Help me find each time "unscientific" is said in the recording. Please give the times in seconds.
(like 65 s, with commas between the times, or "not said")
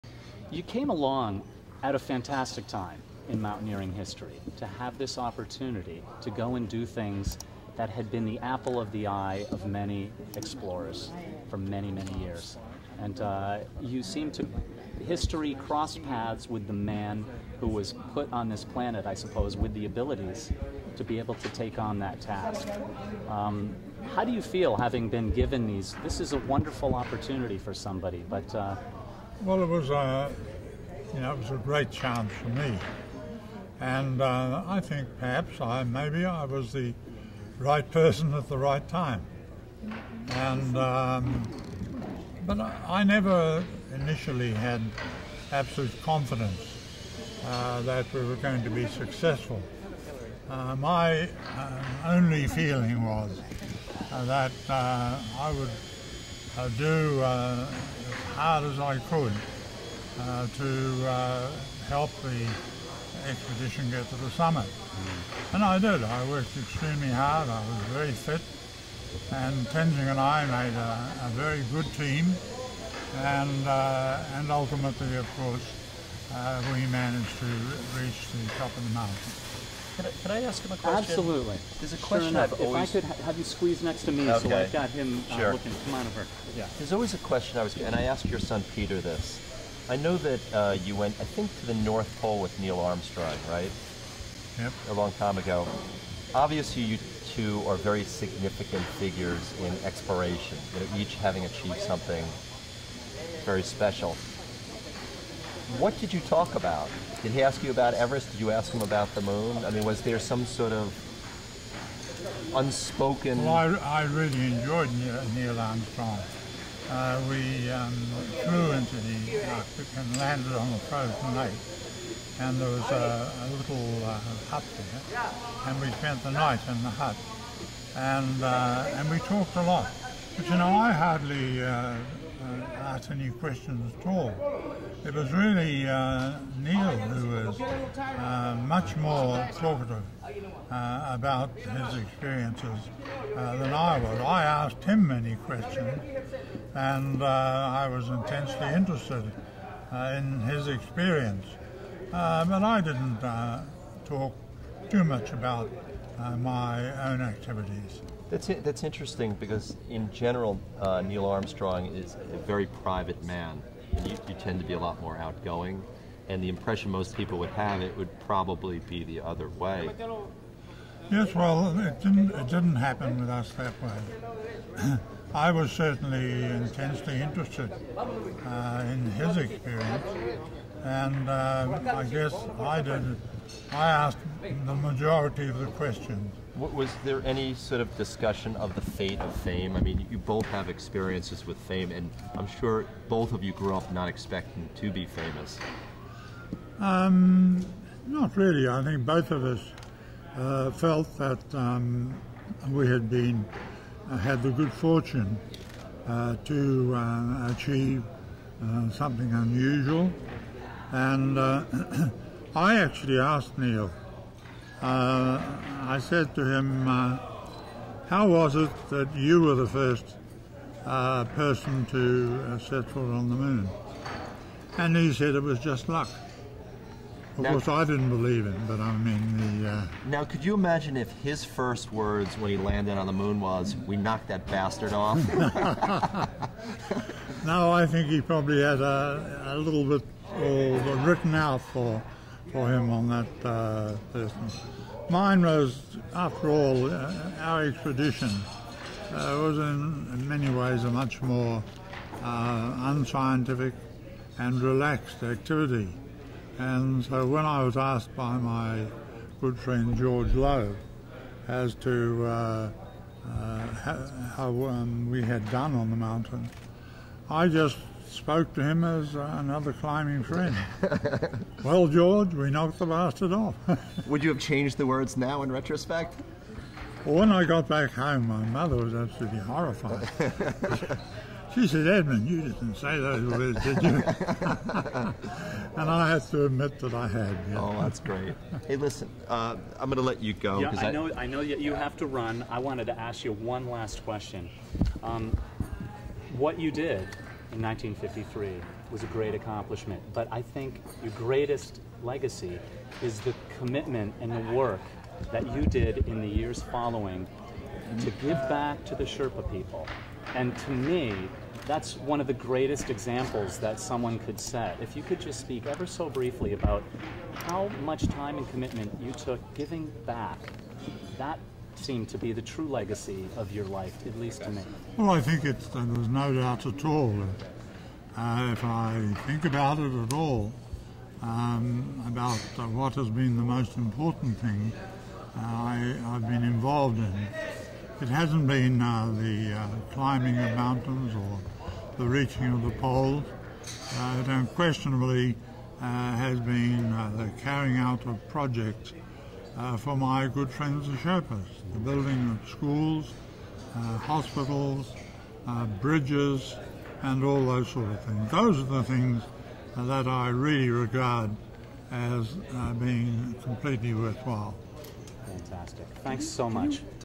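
252 s.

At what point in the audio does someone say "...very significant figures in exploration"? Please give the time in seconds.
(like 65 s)
97 s.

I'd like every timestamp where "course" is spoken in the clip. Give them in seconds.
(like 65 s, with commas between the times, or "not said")
75 s, 227 s.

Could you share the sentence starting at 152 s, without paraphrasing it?
but I didn't talk too much about my own activities.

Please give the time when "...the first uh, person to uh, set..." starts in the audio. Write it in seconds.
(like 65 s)
219 s.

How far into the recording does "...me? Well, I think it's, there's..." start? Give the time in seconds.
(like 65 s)
324 s.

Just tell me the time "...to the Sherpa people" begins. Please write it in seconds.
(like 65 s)
308 s.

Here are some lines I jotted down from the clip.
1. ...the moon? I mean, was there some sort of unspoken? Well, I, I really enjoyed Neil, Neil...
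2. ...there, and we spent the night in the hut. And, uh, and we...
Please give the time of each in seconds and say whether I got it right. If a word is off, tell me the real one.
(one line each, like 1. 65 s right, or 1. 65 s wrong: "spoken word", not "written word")
1. 109 s right
2. 124 s right.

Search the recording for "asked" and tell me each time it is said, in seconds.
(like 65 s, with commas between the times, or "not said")
88 s, 132 s, 144 s, 183 s, 213 s, 257 s.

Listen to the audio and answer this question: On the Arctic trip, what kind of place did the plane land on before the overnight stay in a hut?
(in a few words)
A frozen lake.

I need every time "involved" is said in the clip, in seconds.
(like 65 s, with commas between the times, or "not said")
336 s.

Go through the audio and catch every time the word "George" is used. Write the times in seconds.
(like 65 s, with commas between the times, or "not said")
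259 s, 271 s.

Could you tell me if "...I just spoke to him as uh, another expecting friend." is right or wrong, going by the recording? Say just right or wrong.
wrong.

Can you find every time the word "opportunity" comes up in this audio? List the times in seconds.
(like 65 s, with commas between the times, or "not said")
5 s, 26 s.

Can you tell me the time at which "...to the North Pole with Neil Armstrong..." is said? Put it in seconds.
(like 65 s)
91 s.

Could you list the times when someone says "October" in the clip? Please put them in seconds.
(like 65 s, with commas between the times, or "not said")
not said.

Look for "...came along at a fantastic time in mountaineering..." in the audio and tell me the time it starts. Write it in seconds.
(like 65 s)
0 s.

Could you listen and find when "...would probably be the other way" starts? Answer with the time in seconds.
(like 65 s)
167 s.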